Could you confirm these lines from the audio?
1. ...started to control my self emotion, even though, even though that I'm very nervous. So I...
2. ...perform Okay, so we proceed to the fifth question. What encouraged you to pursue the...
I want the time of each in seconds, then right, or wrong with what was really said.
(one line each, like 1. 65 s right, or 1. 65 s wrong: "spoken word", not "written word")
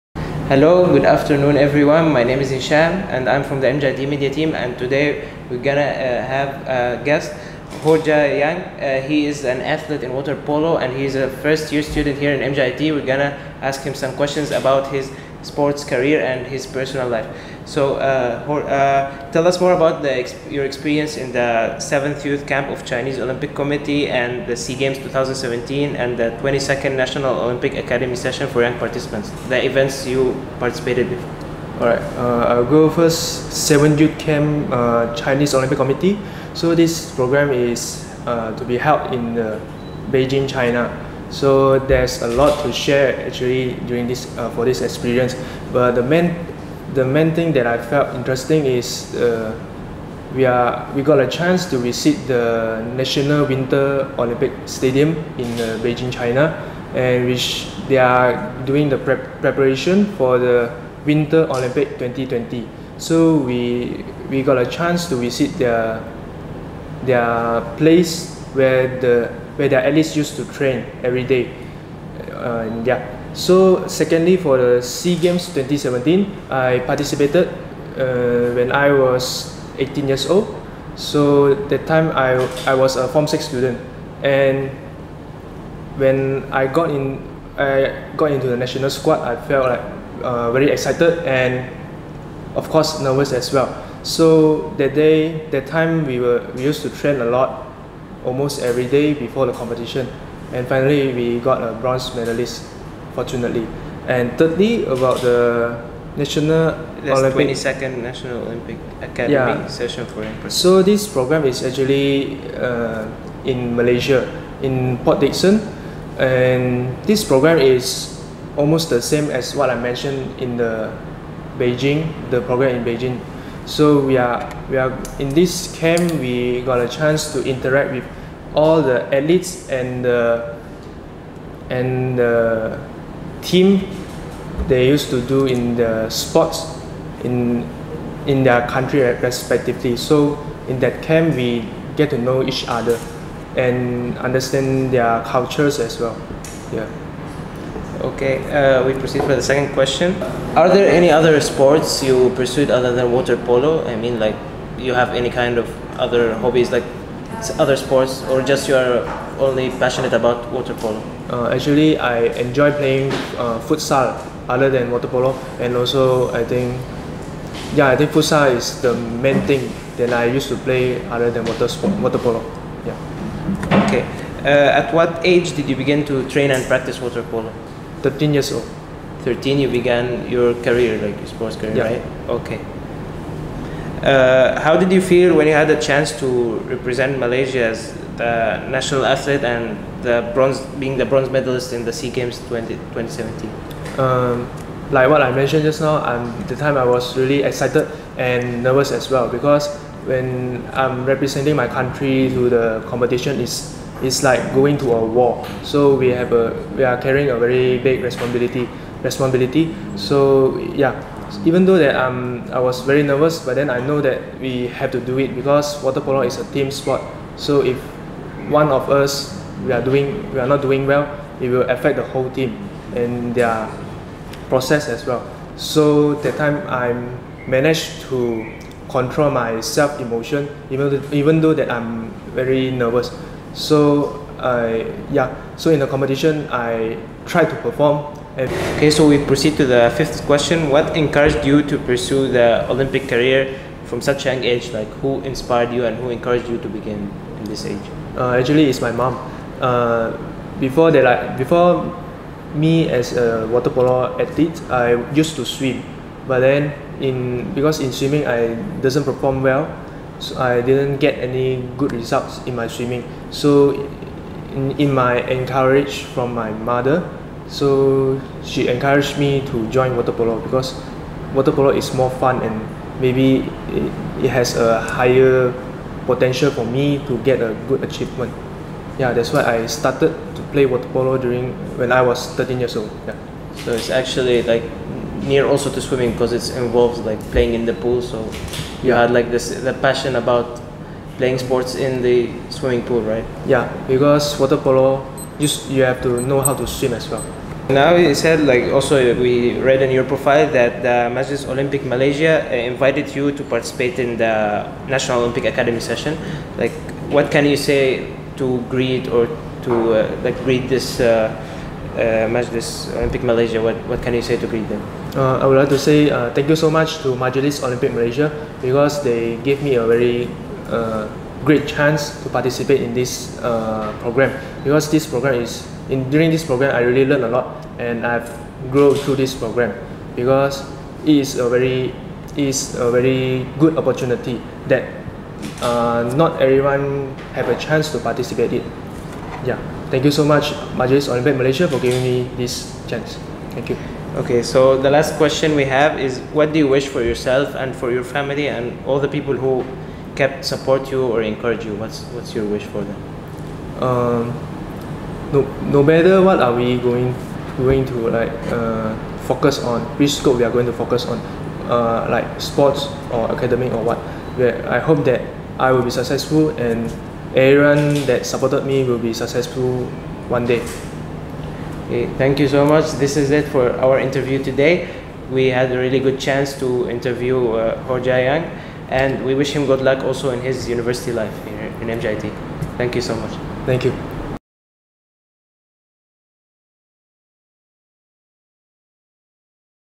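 1. 227 s wrong: "managed", not "started"
2. 237 s right.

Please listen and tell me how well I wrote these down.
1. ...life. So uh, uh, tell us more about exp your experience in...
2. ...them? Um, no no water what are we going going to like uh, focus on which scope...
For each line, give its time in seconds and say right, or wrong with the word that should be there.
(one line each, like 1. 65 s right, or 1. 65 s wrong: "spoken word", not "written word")
1. 17 s right
2. 352 s wrong: "matter", not "water".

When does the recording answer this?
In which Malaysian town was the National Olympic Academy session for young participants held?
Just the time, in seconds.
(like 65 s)
115 s.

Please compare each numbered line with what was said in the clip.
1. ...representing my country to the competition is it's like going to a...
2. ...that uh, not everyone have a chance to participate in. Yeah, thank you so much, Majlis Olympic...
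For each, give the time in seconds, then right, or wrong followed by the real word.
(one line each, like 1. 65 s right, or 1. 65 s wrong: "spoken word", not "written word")
1. 201 s right
2. 334 s right.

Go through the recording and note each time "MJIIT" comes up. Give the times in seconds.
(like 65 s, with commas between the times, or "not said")
3 s, 12 s, 381 s.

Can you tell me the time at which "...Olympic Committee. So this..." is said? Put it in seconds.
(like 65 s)
35 s.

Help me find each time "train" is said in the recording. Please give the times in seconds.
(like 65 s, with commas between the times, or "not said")
70 s, 96 s, 176 s.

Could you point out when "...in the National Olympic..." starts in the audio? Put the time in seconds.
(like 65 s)
303 s.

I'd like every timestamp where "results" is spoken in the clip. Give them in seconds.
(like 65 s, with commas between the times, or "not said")
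261 s.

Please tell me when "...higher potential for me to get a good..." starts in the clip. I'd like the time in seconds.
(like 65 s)
274 s.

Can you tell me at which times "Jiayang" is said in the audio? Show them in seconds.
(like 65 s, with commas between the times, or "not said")
7 s, 378 s.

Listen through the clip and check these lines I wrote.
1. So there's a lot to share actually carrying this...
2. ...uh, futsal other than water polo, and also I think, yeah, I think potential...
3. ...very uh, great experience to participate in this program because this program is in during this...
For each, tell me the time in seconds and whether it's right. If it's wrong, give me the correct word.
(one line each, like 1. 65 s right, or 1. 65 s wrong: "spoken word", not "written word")
1. 41 s wrong: "during", not "carrying"
2. 163 s wrong: "futsal", not "potential"
3. 319 s wrong: "chance", not "experience".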